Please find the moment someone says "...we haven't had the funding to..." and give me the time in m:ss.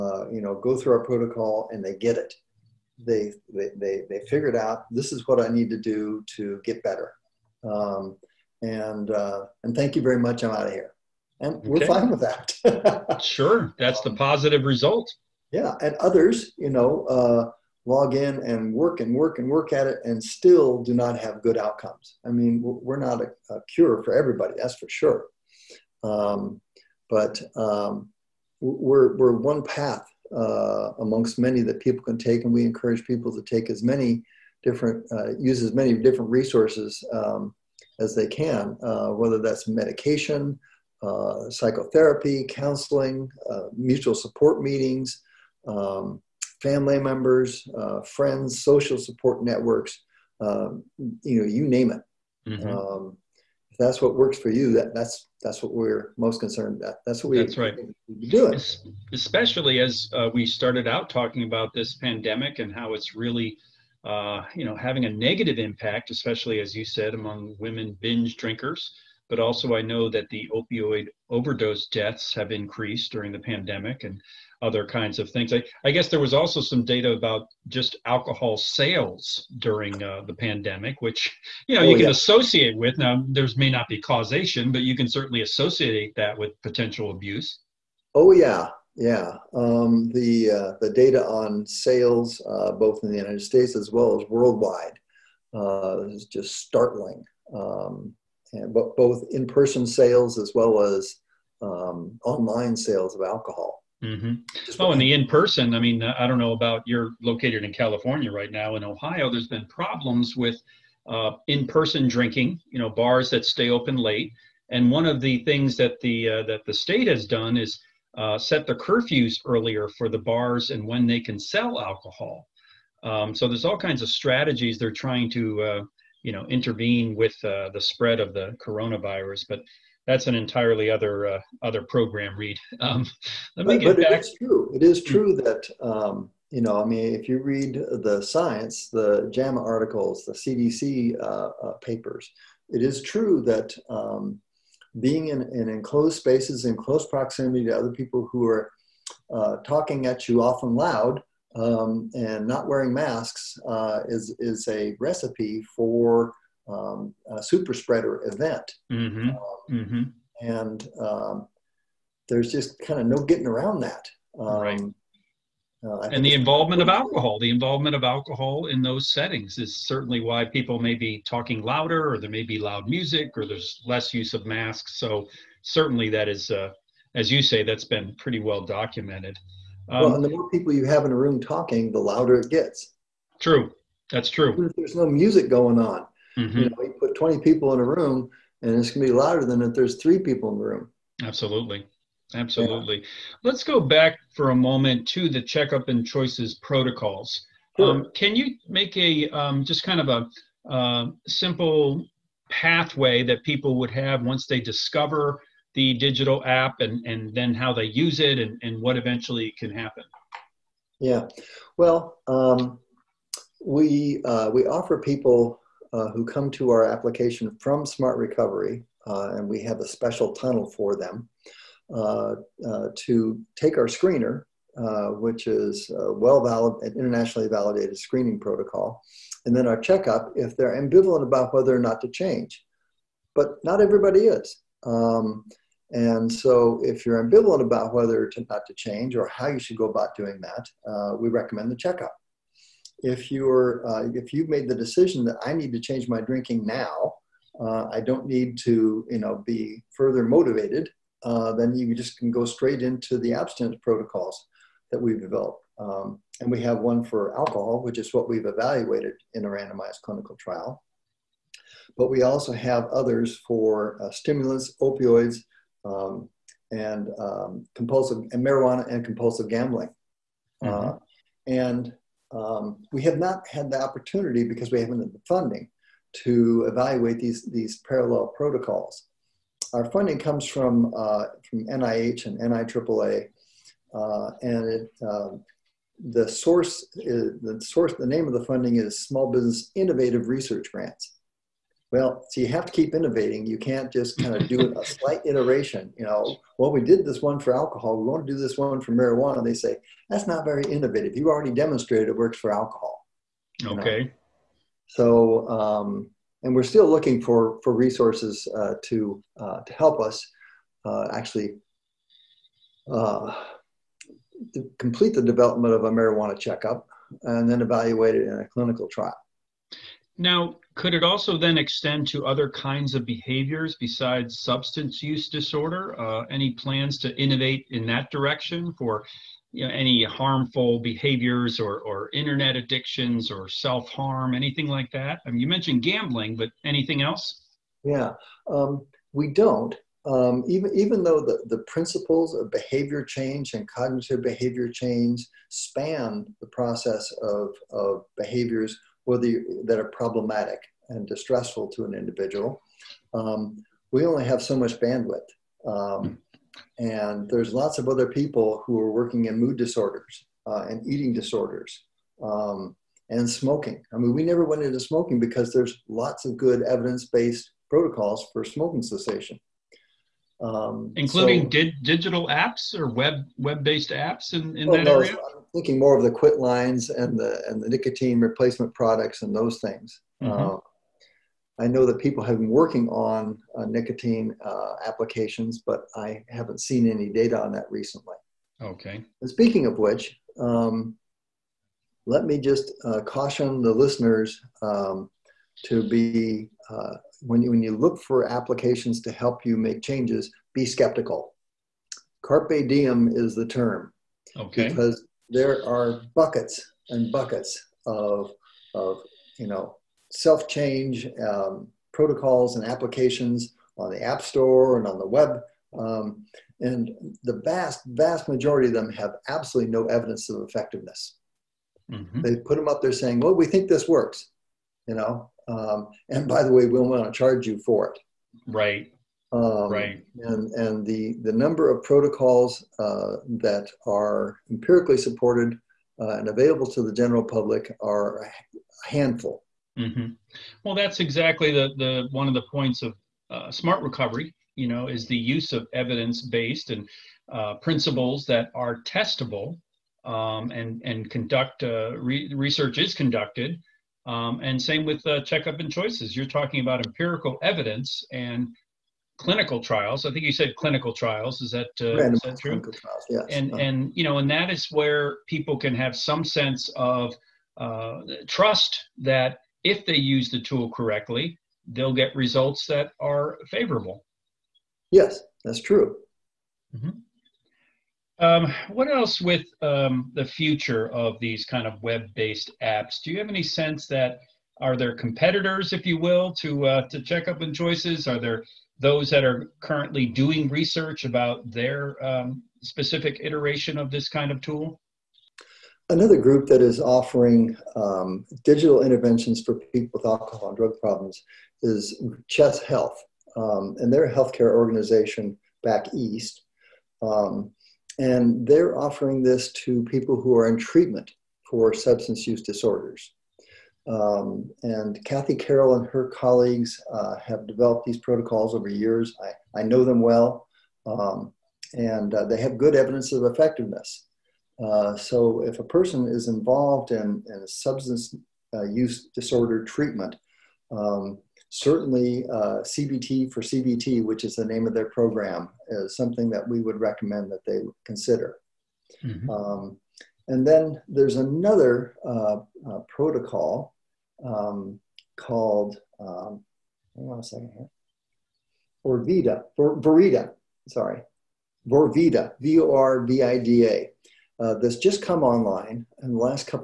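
4:34.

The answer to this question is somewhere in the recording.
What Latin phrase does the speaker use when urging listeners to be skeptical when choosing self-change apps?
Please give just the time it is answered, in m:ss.
6:42.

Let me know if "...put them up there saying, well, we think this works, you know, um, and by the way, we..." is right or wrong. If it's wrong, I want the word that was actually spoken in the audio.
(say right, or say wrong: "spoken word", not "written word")
right.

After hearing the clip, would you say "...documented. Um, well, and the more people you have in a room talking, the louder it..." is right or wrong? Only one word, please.
right.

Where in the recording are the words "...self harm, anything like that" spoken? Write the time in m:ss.
5:33.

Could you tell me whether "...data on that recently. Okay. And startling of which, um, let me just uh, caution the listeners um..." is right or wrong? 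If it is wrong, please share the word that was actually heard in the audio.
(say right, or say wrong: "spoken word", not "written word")
wrong: "speaking", not "startling".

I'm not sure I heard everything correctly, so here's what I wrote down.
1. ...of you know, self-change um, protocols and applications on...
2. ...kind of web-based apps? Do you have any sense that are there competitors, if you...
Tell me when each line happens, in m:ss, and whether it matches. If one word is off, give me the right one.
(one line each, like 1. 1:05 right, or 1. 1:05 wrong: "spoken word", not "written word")
1. 6:48 right
2. 8:01 right.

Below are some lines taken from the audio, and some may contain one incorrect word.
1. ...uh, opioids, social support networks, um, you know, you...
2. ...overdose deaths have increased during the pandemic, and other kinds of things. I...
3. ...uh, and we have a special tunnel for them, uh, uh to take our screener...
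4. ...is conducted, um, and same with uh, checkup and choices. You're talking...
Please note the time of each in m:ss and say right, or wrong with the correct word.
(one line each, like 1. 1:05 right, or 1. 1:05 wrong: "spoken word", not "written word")
1. 0:47 wrong: "friends", not "opioids"
2. 1:11 right
3. 3:39 right
4. 7:32 right.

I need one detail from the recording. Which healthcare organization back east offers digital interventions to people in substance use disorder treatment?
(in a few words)
Chess Health.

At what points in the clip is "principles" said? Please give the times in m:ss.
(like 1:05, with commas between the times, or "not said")
5:41, 7:27.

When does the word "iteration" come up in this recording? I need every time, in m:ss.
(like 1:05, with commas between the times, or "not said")
4:55, 8:13.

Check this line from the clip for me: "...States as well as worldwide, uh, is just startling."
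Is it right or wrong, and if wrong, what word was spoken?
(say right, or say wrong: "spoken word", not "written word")
right.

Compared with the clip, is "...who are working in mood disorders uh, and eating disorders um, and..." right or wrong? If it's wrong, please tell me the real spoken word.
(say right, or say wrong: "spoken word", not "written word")
right.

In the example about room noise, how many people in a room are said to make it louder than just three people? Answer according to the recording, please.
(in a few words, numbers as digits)
20.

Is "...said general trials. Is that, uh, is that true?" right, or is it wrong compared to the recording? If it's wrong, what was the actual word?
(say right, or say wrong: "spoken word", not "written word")
wrong: "clinical", not "general".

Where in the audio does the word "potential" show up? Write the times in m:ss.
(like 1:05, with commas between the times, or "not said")
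1:26.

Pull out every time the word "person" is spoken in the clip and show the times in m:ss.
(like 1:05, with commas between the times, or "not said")
1:39, 1:45, 1:51, 8:45.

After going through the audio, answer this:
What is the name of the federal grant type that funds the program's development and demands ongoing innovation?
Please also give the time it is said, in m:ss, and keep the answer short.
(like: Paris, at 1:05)
Small Business Innovative Research, at 4:49.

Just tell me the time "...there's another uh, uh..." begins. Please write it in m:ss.
9:00.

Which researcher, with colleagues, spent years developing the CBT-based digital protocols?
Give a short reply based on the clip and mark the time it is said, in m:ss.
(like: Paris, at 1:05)
Kathy Carroll, at 8:35.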